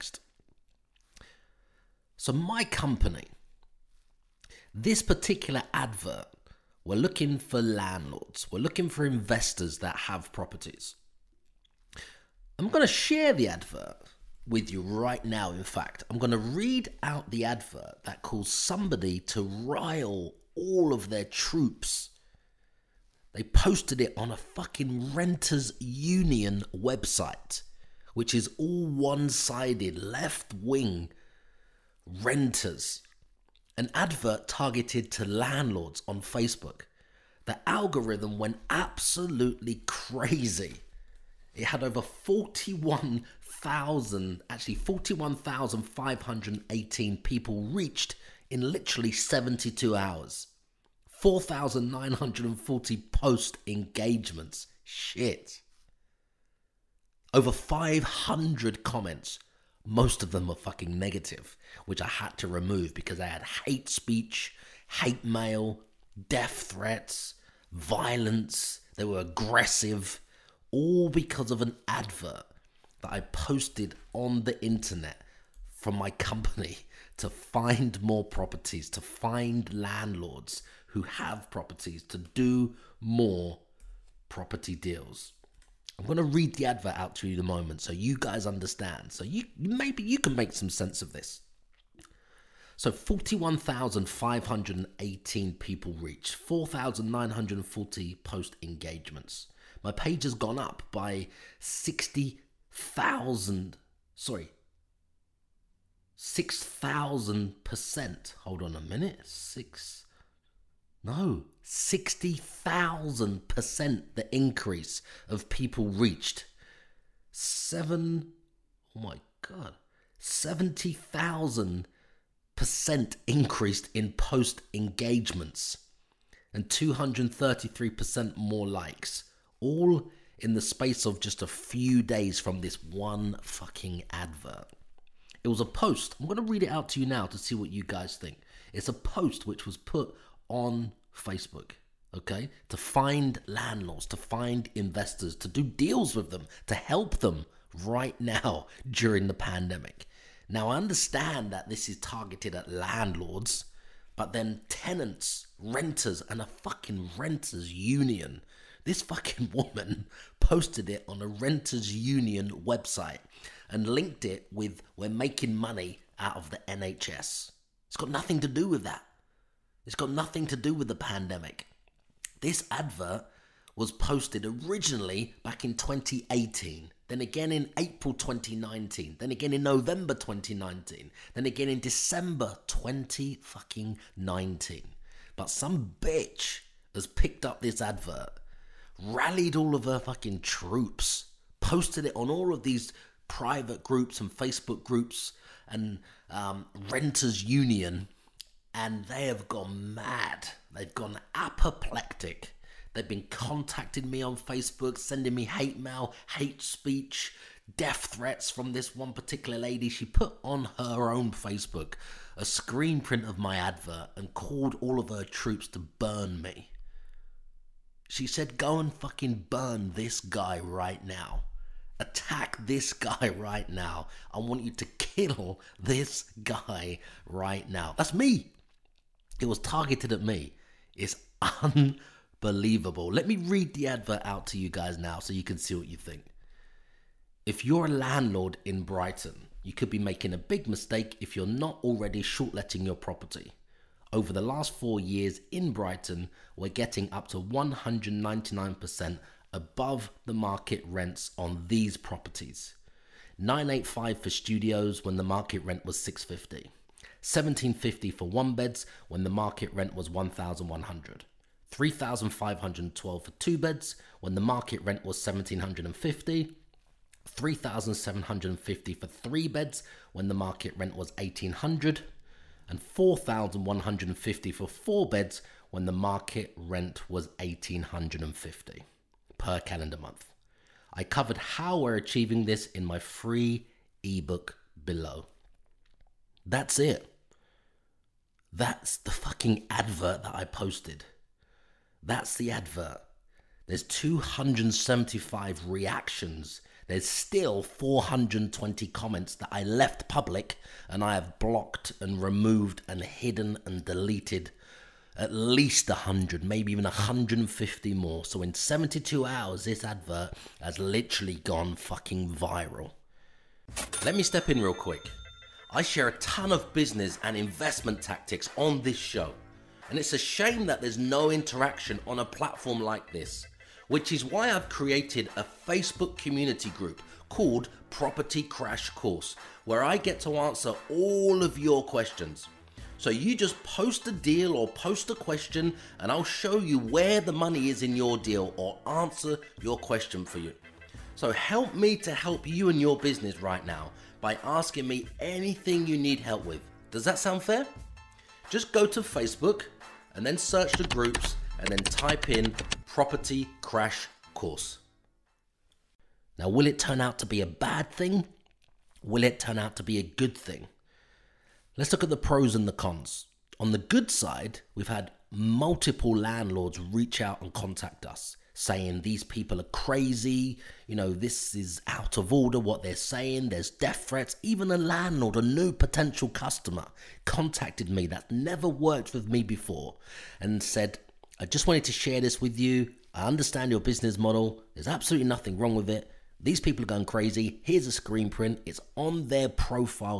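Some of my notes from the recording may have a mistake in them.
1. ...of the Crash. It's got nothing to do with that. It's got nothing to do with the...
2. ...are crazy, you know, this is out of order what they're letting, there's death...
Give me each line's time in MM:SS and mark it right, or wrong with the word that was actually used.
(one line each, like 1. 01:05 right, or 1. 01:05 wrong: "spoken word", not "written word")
1. 02:46 wrong: "NHS", not "Crash"
2. 06:09 wrong: "saying", not "letting".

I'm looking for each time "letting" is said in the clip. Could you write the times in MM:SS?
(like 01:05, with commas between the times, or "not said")
04:02.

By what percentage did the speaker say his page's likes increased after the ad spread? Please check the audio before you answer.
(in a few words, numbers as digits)
233%.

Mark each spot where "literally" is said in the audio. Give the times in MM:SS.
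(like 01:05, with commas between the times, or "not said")
00:48, 05:10.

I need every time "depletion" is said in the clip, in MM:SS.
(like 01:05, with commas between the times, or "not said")
not said.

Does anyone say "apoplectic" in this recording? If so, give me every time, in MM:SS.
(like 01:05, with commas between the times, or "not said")
03:21.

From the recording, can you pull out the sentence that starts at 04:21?
3512 for two beds when the market rent was 1750.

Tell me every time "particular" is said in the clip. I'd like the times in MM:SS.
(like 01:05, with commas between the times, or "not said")
00:05, 03:29.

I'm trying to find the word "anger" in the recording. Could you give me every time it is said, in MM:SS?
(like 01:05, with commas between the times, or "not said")
not said.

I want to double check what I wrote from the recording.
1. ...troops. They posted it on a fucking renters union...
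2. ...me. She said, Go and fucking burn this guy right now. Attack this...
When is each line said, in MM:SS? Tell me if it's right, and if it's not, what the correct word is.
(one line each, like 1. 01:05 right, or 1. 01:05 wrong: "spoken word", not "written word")
1. 00:21 right
2. 03:36 right.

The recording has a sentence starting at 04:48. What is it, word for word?
That's the fucking advert that I posted.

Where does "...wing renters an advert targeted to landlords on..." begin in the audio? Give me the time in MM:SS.
00:30.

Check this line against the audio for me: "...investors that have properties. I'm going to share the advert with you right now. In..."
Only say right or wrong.
right.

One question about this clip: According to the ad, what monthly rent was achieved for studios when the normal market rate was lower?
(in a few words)
985.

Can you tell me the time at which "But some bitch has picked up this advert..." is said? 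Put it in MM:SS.
03:05.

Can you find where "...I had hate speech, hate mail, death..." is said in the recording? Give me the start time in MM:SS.
01:03.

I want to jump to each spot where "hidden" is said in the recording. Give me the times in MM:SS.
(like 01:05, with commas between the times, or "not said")
05:03.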